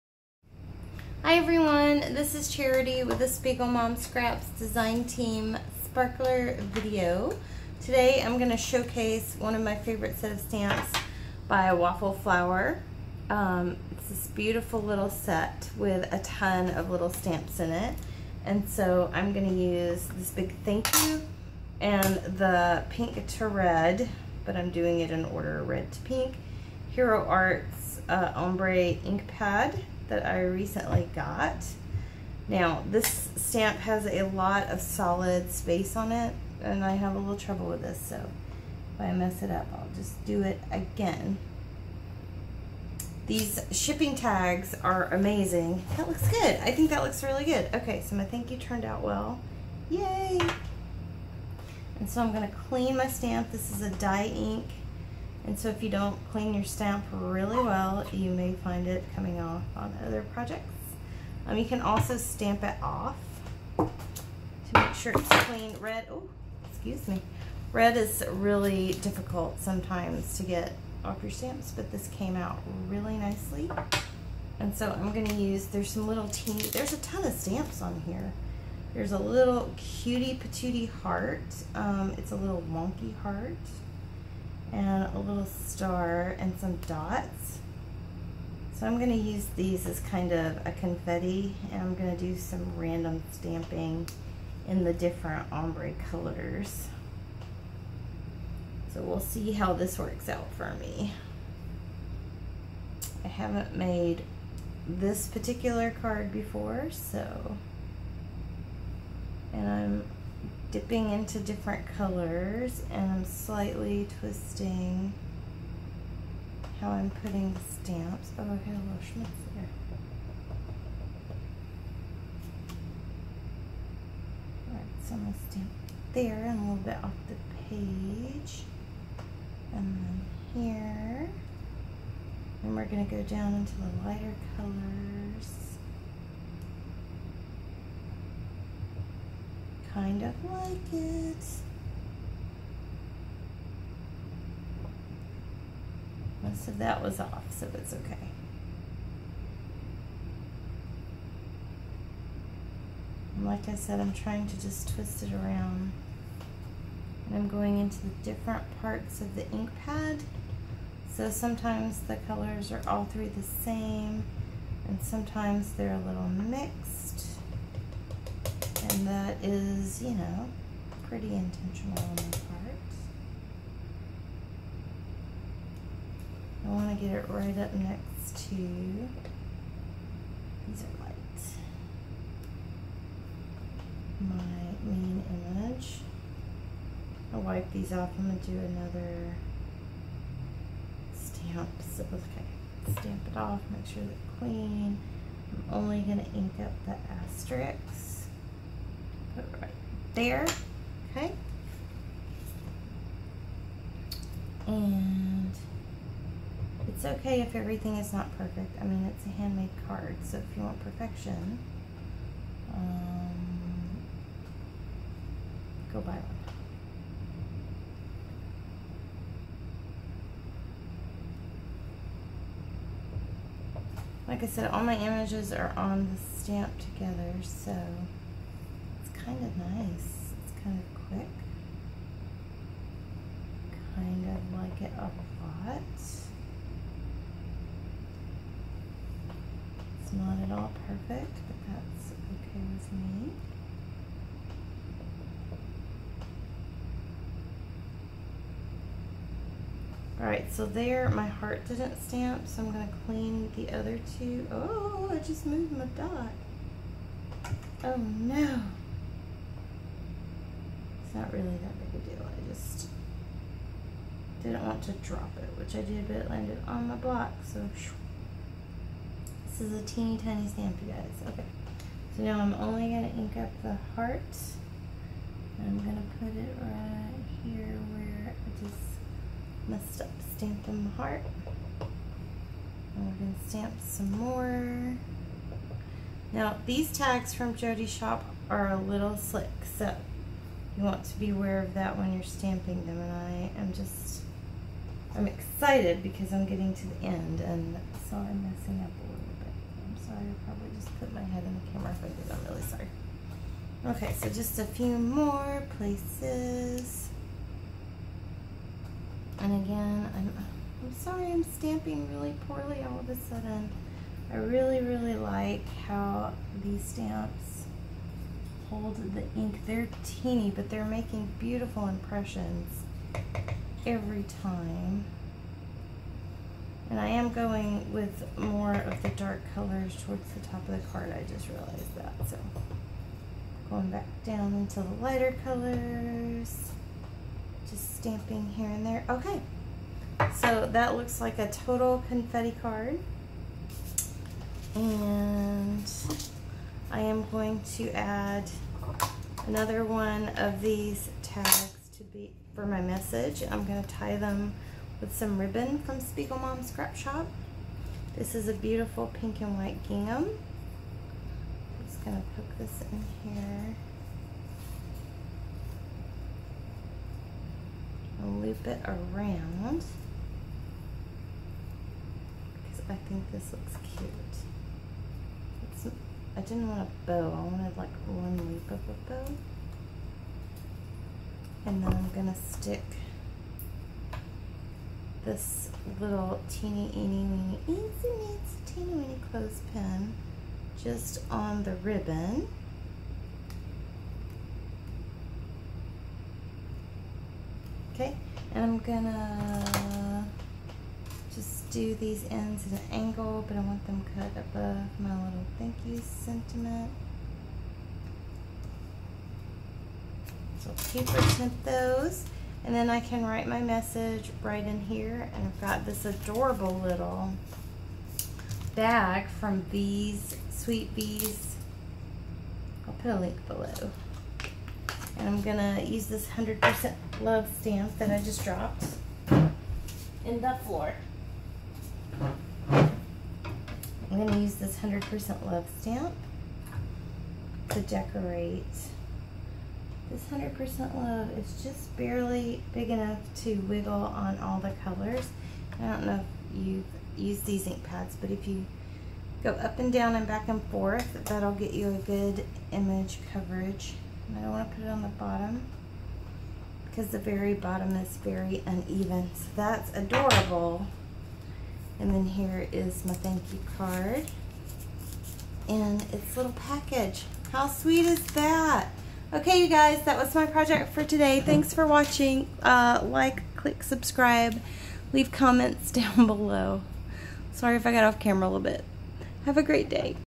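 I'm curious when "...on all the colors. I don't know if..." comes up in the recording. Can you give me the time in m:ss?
7:23.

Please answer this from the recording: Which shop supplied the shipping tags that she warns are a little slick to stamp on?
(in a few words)
Jody Shop.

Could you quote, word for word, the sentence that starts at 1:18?
There's a little cutie patootie heart.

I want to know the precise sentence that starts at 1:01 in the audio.
Um, you can also stamp it off to make sure it's clean.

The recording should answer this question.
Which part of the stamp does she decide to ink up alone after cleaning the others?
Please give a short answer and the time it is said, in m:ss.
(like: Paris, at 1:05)
the asterisks, at 3:16.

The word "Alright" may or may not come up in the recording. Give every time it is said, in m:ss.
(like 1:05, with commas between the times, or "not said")
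2:04, 4:10.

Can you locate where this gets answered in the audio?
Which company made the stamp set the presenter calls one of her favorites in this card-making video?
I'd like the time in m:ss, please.
0:11.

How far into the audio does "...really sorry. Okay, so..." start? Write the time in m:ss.
5:02.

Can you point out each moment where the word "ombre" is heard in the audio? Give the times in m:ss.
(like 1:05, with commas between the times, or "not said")
0:28, 1:35.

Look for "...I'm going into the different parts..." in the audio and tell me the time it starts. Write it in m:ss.
2:37.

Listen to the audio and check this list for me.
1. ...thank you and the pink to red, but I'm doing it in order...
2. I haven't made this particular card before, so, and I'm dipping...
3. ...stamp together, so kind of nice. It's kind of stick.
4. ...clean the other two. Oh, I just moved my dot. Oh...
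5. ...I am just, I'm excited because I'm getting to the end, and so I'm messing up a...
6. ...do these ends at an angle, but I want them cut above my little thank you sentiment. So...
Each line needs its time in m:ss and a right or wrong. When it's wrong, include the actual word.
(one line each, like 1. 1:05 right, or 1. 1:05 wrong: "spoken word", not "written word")
1. 0:20 right
2. 1:43 right
3. 3:46 wrong: "quick", not "stick"
4. 4:13 right
5. 4:53 right
6. 6:41 right.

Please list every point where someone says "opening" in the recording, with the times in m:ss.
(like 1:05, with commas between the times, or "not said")
not said.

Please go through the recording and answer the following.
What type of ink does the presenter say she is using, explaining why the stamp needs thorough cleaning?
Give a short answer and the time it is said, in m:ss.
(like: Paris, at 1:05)
dye ink, at 0:53.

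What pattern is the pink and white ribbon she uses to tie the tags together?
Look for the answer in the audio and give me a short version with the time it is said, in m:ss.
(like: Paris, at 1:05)
gingham, at 5:59.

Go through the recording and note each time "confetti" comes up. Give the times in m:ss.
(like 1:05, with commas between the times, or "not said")
1:30, 5:42.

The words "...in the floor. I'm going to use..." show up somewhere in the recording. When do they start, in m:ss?
7:10.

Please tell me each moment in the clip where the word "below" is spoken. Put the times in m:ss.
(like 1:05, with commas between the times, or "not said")
7:03, 7:56.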